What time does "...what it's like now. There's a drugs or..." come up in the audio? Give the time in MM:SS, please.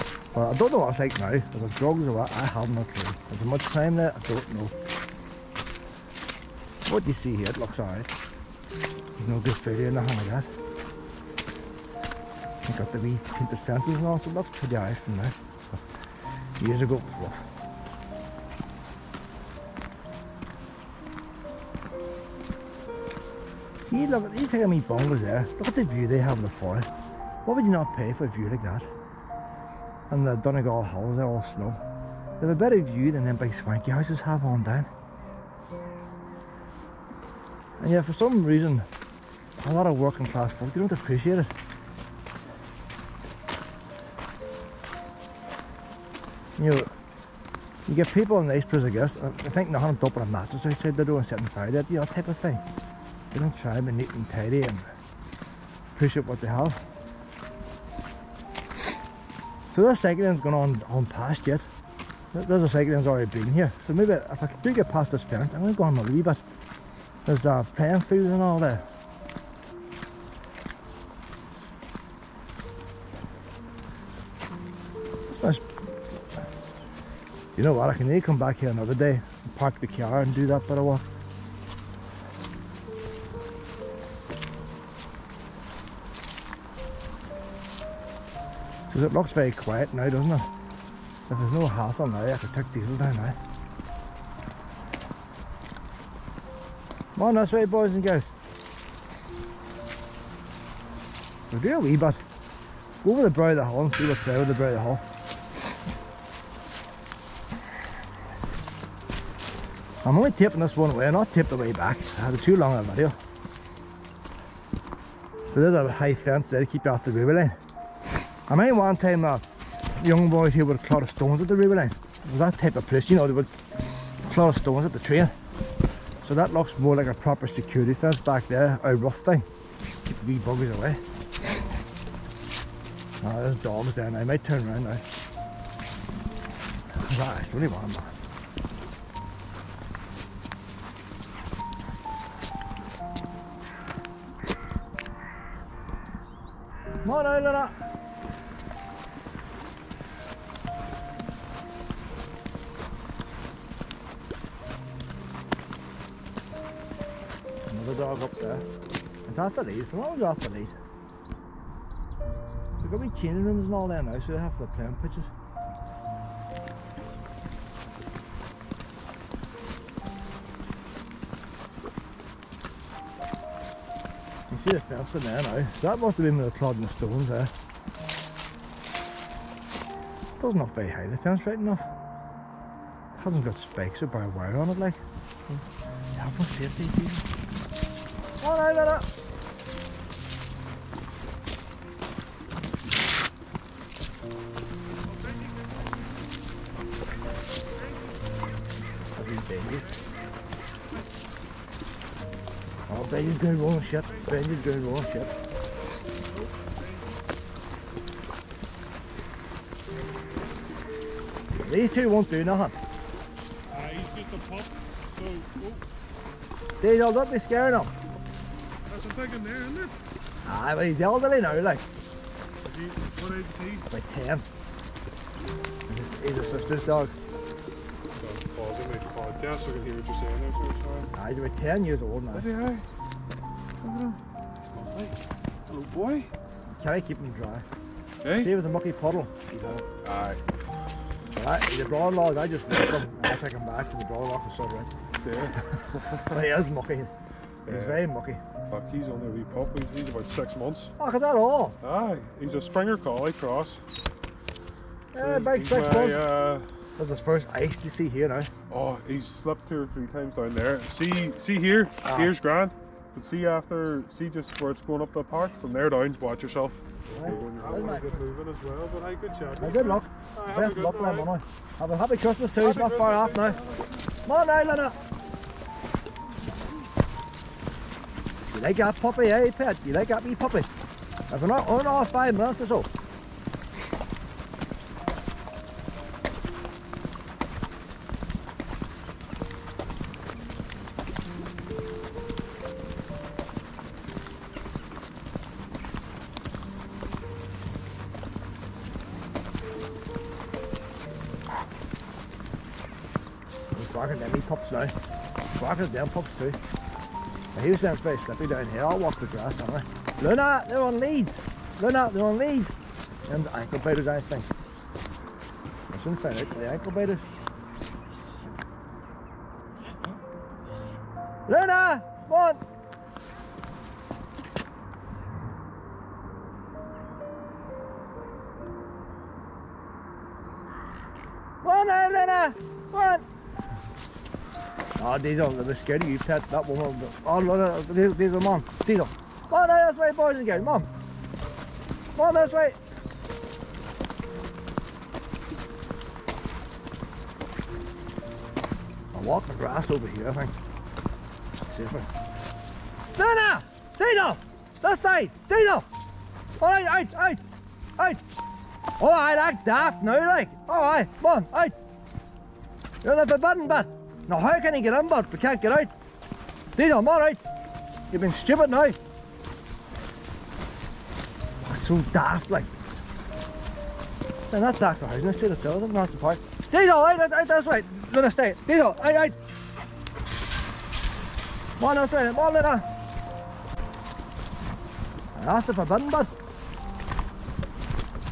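00:00.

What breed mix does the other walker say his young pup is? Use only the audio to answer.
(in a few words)
Springer Collie cross.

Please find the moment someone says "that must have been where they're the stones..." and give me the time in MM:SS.
02:55.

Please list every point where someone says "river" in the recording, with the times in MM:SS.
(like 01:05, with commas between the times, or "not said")
01:57, 02:01.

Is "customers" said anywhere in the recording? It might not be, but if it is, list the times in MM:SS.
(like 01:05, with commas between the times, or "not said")
not said.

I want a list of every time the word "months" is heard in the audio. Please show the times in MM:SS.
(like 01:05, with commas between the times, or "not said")
04:10, 04:15, 04:42.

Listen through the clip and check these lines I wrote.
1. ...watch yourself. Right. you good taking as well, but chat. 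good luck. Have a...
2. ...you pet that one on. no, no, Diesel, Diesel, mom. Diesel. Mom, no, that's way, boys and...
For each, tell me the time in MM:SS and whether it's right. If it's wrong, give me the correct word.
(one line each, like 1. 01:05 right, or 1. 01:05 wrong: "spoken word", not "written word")
1. 04:26 wrong: "moving", not "taking"
2. 05:36 right.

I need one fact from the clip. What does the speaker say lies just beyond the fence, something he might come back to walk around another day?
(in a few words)
playing fields.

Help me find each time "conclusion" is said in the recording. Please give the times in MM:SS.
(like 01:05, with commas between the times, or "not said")
not said.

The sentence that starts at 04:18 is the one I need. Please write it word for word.
Oh, he's slipped two or three times down there.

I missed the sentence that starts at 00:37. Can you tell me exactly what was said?
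And yeah, for some reason, a lot of working class folk, they don't appreciate it.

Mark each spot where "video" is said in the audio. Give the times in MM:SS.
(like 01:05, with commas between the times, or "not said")
01:52.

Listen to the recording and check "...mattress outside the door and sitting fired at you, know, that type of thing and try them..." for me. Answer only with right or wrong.
right.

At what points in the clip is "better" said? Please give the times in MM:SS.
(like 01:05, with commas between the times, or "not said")
00:32.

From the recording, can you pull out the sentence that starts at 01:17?
I can maybe come back here another day and park the car and do that bit of walk.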